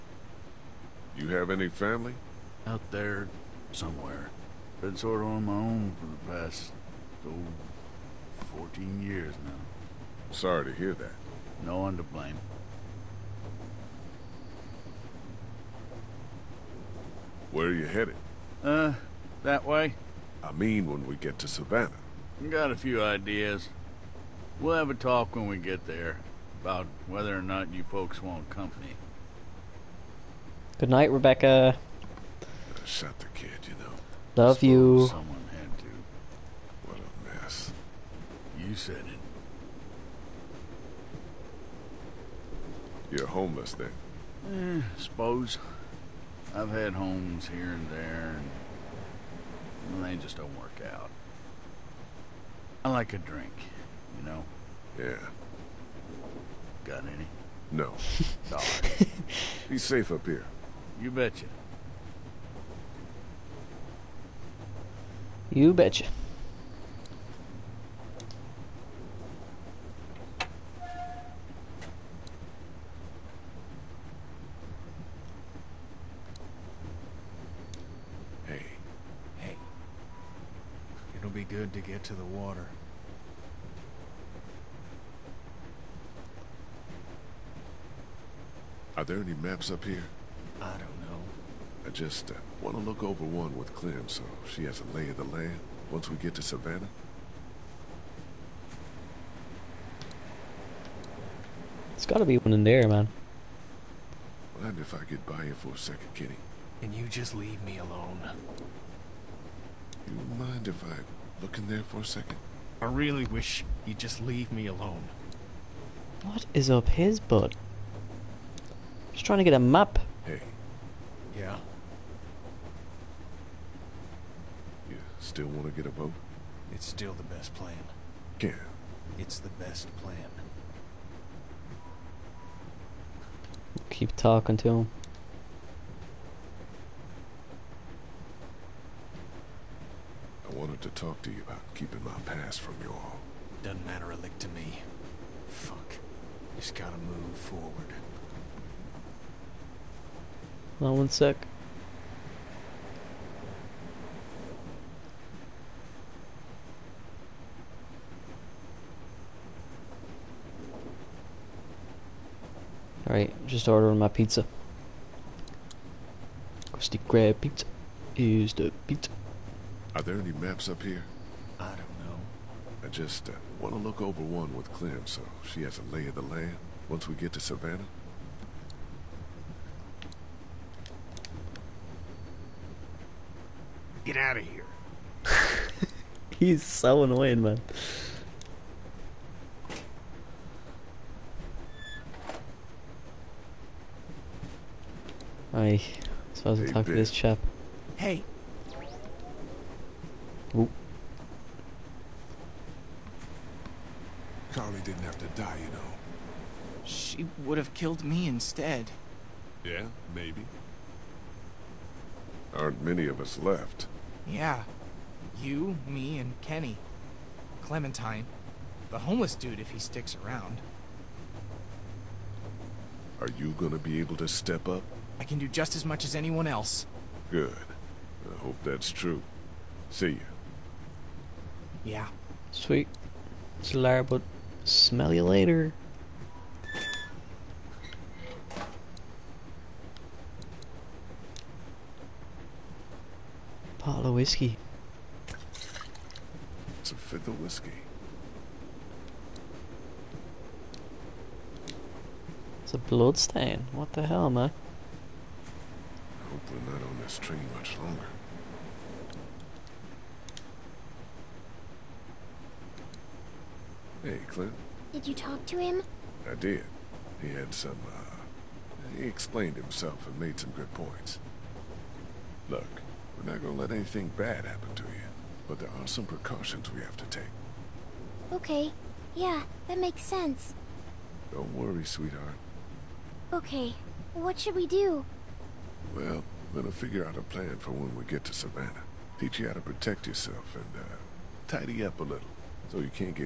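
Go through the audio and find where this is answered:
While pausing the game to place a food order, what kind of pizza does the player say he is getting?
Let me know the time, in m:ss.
2:46.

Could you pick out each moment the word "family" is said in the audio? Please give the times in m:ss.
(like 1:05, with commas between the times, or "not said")
0:01.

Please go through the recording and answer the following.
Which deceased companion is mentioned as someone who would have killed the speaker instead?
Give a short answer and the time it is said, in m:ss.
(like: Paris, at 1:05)
Carley, at 3:24.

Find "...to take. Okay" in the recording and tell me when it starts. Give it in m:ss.
4:36.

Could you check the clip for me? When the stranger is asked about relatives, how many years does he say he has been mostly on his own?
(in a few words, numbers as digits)
14.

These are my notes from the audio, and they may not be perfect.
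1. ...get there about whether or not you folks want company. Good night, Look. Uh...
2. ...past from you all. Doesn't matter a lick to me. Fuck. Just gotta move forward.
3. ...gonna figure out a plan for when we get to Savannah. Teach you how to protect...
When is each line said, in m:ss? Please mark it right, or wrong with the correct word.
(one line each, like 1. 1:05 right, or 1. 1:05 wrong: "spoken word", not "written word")
1. 0:25 wrong: "Rebecca", not "Look"
2. 2:22 right
3. 4:46 right.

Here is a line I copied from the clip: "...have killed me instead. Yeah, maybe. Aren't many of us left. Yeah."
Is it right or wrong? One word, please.
right.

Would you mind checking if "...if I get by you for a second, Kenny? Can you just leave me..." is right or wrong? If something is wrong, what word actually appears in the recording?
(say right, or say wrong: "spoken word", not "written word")
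right.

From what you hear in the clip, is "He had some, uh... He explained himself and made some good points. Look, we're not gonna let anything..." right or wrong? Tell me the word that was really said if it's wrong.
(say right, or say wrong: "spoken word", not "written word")
right.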